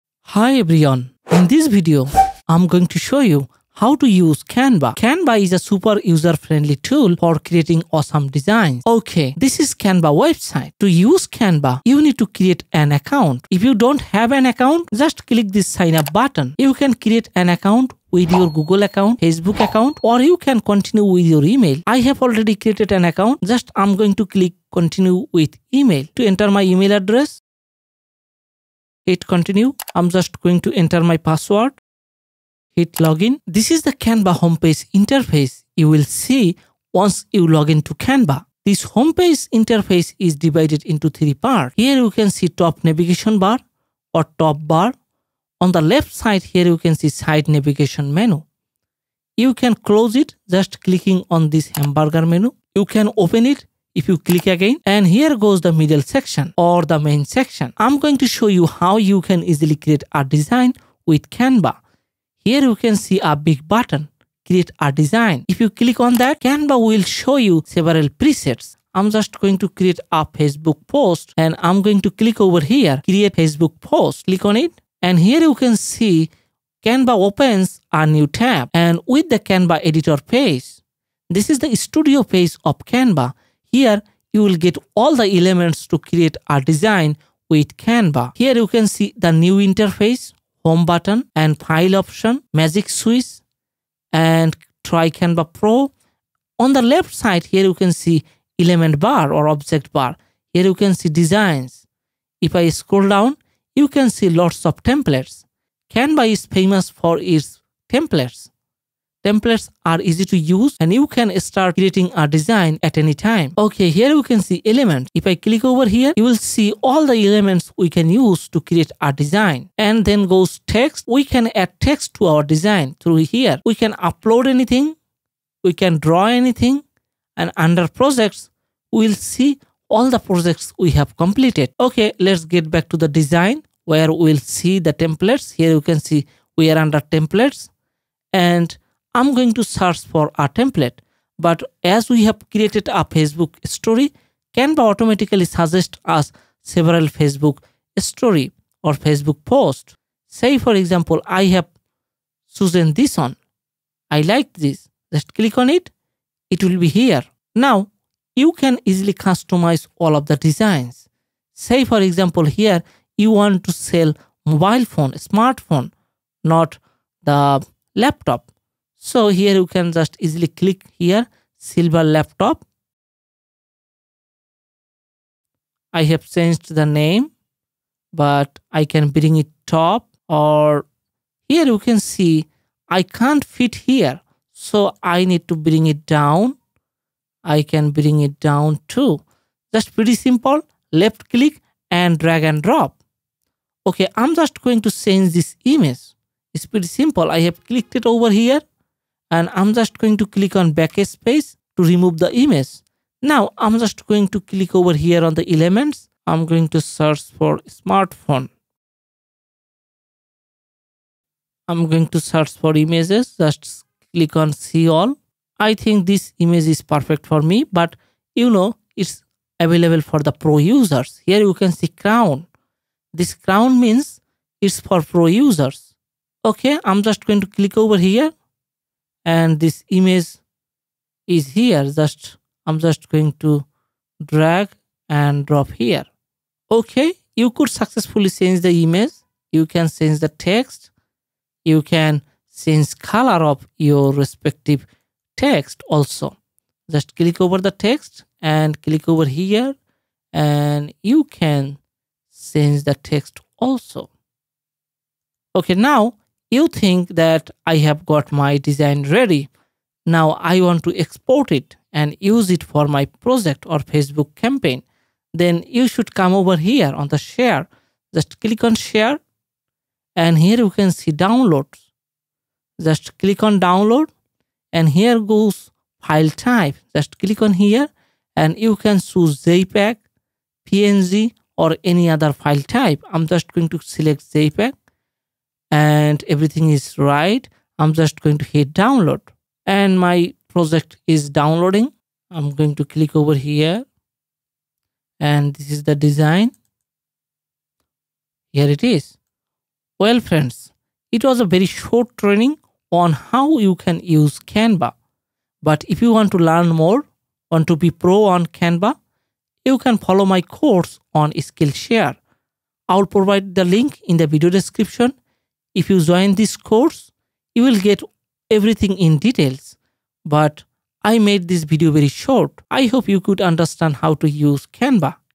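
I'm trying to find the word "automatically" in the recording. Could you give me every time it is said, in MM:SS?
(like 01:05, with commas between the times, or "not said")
02:24.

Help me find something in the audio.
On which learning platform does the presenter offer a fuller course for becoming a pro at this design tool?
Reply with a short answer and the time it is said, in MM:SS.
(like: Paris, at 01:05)
Skillshare, at 05:11.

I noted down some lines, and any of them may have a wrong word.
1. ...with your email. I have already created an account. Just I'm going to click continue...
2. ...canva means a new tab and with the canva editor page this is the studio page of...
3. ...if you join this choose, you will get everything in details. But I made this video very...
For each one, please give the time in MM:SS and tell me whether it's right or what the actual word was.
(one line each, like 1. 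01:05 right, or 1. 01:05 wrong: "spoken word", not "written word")
1. 00:21 right
2. 01:16 wrong: "opens", not "means"
3. 05:15 wrong: "course", not "choose".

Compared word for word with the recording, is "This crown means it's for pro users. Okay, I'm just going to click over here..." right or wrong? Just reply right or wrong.
right.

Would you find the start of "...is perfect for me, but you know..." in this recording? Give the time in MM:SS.
03:36.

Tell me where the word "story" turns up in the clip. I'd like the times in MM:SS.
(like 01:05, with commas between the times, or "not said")
02:23, 02:27.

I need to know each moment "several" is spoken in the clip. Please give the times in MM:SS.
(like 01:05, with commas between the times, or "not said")
01:07, 02:26.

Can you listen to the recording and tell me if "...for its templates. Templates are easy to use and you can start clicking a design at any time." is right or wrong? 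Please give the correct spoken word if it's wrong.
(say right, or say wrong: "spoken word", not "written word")
wrong: "creating", not "clicking".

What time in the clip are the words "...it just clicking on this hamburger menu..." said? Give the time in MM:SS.
00:50.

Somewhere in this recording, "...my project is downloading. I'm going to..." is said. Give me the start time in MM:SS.
04:49.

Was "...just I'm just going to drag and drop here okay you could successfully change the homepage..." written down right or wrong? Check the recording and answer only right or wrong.
wrong.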